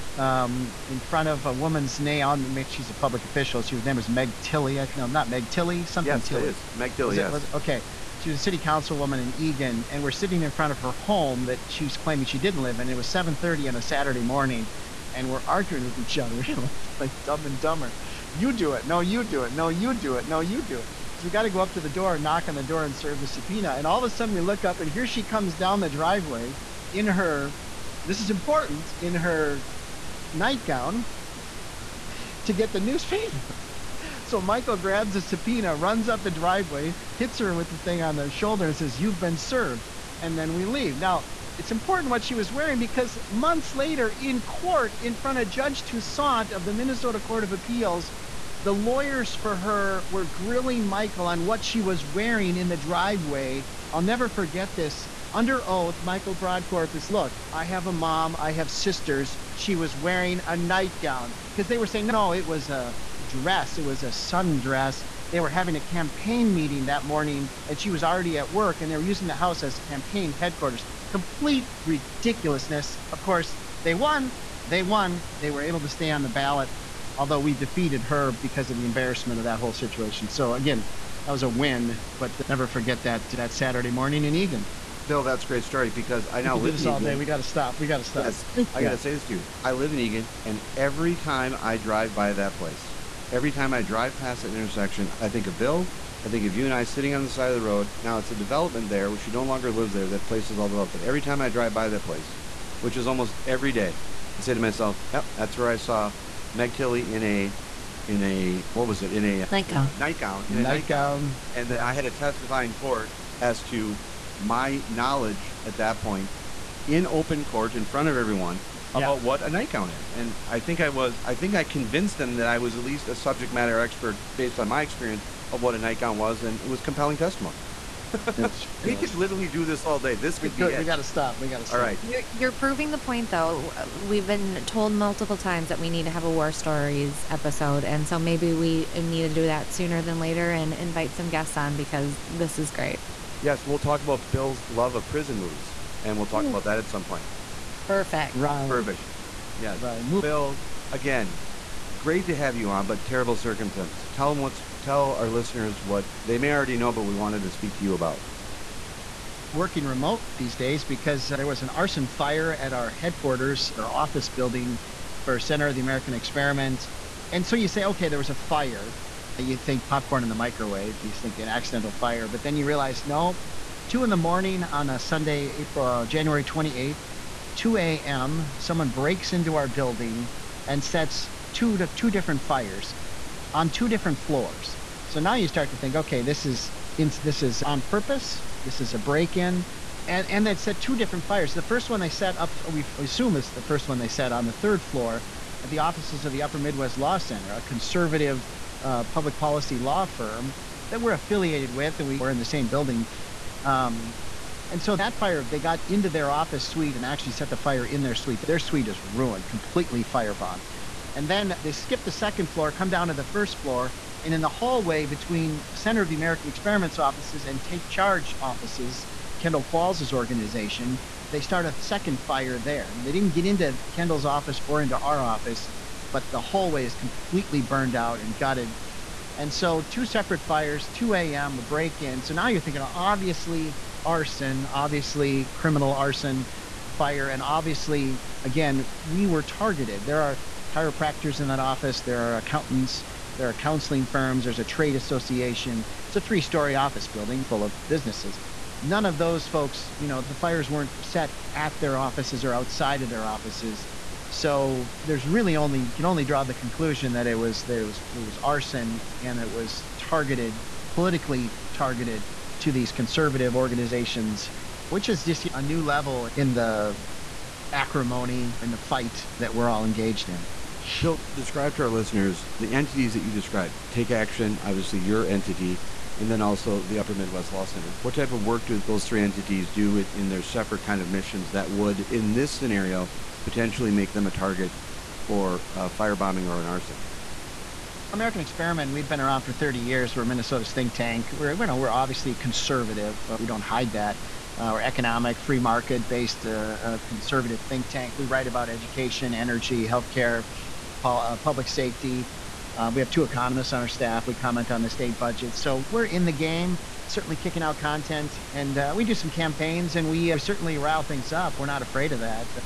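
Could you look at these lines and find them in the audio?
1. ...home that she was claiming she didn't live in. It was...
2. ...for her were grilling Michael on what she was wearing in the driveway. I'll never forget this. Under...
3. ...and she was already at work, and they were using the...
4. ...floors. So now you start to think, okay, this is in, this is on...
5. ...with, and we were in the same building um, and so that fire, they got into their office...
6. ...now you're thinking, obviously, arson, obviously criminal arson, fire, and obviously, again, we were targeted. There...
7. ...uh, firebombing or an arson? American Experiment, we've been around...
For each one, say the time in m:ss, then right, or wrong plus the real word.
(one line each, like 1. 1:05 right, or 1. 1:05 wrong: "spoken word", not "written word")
1. 0:10 right
2. 0:49 right
3. 1:07 right
4. 3:04 right
5. 3:21 right
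6. 3:52 right
7. 4:45 right.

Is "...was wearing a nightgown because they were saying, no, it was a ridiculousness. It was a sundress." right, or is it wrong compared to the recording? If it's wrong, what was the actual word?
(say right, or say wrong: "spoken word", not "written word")
wrong: "dress", not "ridiculousness".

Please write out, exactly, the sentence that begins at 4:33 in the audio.
Take Action, obviously your entity, and then also the Upper Midwest Law Center.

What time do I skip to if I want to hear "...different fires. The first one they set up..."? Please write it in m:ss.
3:10.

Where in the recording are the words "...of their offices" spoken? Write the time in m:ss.
4:13.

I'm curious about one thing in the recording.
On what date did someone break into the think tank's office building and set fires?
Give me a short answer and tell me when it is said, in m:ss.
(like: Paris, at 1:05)
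January 28th, at 2:56.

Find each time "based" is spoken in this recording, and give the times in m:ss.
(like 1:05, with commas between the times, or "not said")
2:04, 4:56.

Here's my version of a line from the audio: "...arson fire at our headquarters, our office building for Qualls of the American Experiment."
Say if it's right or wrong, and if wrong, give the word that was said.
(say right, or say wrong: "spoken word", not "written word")
wrong: "Center", not "Qualls".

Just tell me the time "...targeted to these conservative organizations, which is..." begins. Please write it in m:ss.
4:21.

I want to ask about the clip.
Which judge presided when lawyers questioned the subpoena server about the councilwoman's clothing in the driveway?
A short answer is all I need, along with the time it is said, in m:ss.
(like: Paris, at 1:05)
Judge Toussaint, at 0:45.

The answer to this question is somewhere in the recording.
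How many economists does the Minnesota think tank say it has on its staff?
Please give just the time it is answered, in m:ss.
5:03.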